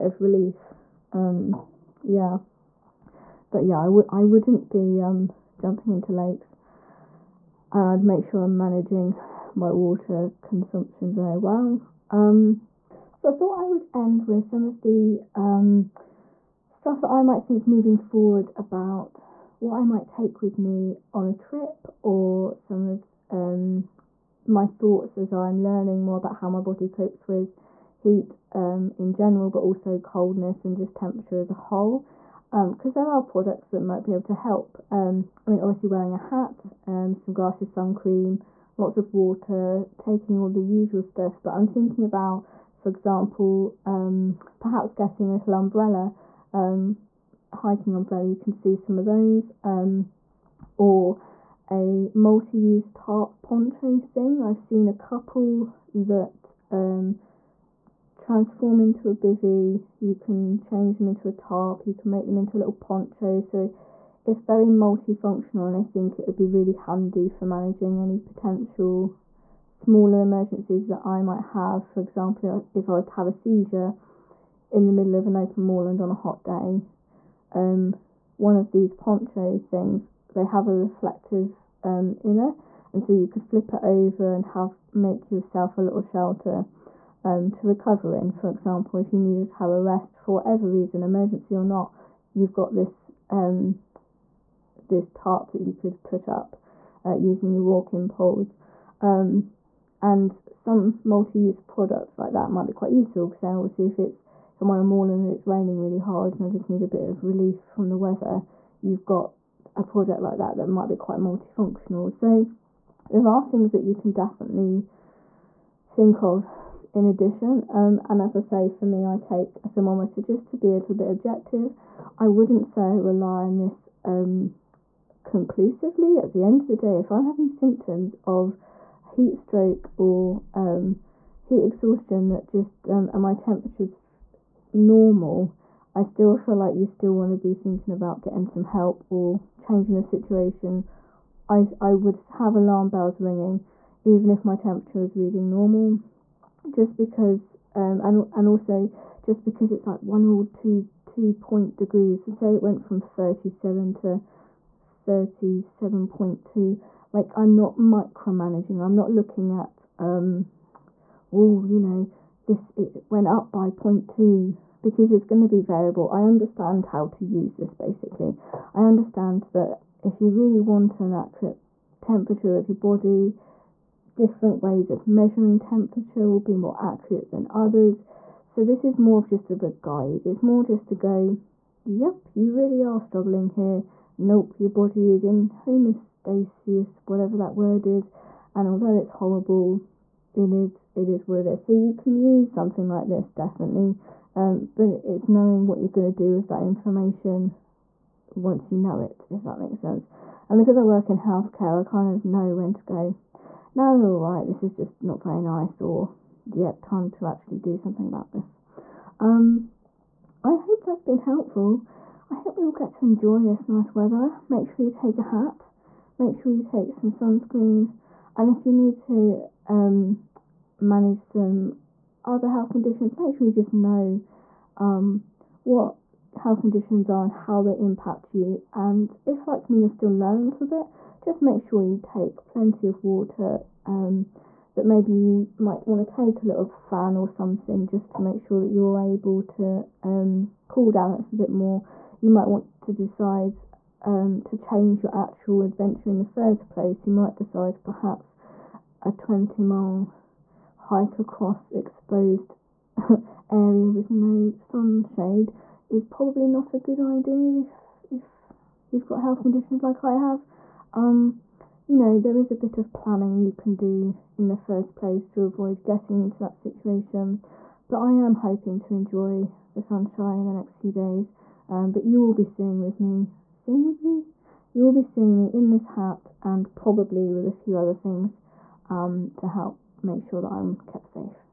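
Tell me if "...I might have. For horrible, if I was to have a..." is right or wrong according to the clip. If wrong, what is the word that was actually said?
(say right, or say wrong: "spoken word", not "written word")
wrong: "example", not "horrible".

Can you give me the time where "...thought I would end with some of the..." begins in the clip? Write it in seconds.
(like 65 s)
13 s.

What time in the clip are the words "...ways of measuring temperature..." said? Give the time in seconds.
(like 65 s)
174 s.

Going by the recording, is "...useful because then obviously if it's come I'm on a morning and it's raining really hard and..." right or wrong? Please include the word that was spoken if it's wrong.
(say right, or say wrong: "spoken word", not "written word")
right.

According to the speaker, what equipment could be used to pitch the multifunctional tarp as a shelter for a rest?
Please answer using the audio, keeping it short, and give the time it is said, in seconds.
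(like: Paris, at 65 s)
walking poles, at 97 s.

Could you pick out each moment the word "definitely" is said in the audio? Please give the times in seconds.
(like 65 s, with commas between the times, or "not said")
114 s, 193 s.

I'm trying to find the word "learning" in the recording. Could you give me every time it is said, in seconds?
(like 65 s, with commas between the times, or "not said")
25 s, 230 s.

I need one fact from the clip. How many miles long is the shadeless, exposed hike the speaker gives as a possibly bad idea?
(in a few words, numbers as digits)
20.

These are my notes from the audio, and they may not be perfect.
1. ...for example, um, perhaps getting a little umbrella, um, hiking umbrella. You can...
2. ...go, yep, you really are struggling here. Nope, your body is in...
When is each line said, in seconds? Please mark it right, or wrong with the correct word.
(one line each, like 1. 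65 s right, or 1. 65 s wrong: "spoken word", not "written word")
1. 42 s right
2. 180 s right.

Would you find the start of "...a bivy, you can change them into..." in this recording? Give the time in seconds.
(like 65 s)
59 s.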